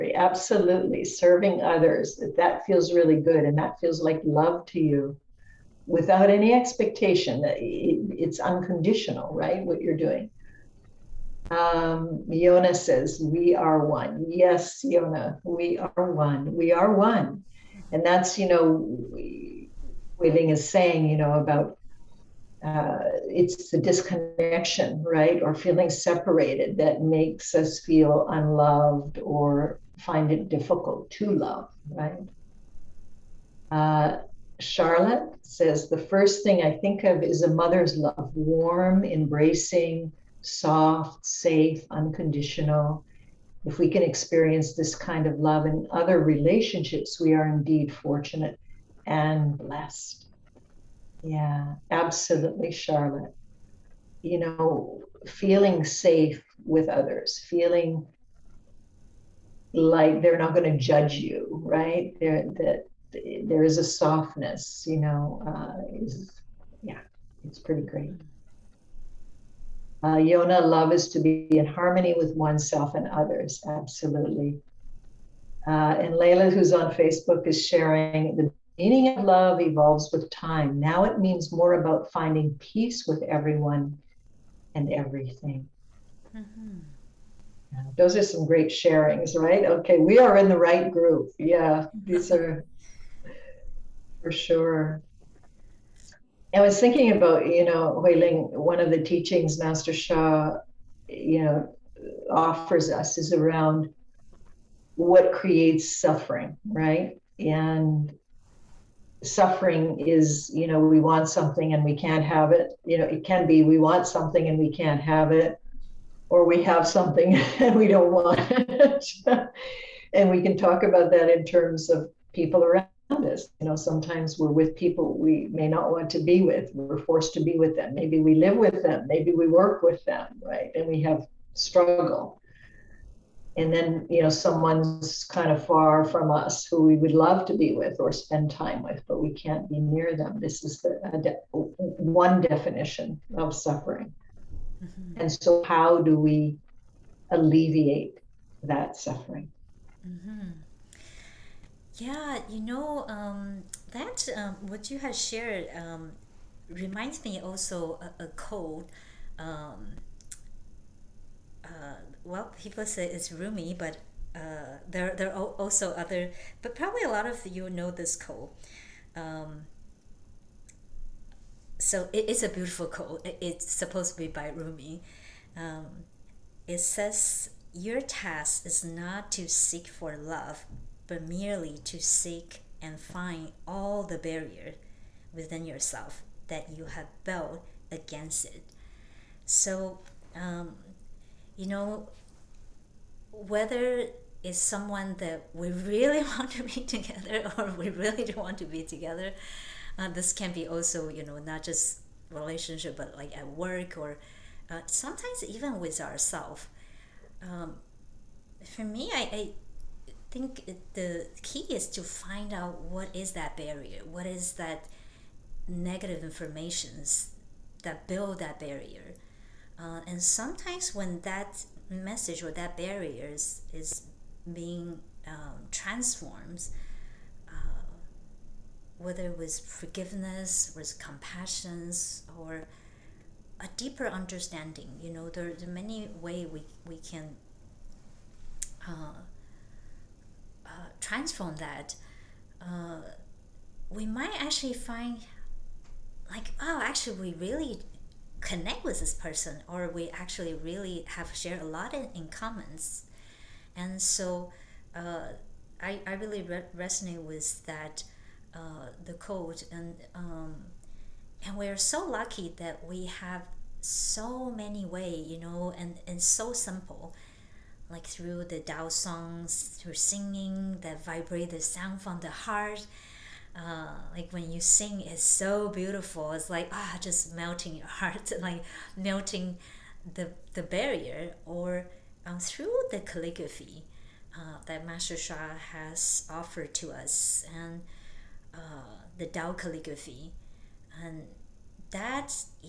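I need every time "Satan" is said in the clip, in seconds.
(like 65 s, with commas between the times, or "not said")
not said.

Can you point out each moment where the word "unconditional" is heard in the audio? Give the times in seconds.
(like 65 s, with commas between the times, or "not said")
8 s, 41 s.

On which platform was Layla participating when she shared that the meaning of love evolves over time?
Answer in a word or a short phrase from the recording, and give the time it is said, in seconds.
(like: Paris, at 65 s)
Facebook, at 76 s.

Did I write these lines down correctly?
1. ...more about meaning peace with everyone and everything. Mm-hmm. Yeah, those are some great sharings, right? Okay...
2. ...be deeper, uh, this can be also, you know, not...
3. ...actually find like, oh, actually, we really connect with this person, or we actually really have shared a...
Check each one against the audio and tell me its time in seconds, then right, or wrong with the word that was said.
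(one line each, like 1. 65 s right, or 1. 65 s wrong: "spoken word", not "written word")
1. 81 s wrong: "finding", not "meaning"
2. 198 s wrong: "together", not "deeper"
3. 244 s right.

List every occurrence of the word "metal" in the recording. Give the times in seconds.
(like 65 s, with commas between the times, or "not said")
not said.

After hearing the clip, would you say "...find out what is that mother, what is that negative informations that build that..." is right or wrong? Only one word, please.
wrong.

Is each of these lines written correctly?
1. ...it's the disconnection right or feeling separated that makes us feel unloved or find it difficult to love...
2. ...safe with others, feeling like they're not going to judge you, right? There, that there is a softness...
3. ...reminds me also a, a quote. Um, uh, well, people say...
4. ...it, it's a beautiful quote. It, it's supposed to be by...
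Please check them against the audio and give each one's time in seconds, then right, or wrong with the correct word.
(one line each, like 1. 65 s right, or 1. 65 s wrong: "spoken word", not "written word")
1. 23 s right
2. 55 s right
3. 156 s right
4. 172 s right.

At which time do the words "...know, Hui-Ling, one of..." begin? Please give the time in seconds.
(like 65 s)
97 s.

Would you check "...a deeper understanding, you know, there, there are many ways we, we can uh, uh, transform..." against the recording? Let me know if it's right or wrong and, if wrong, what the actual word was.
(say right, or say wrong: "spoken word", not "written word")
right.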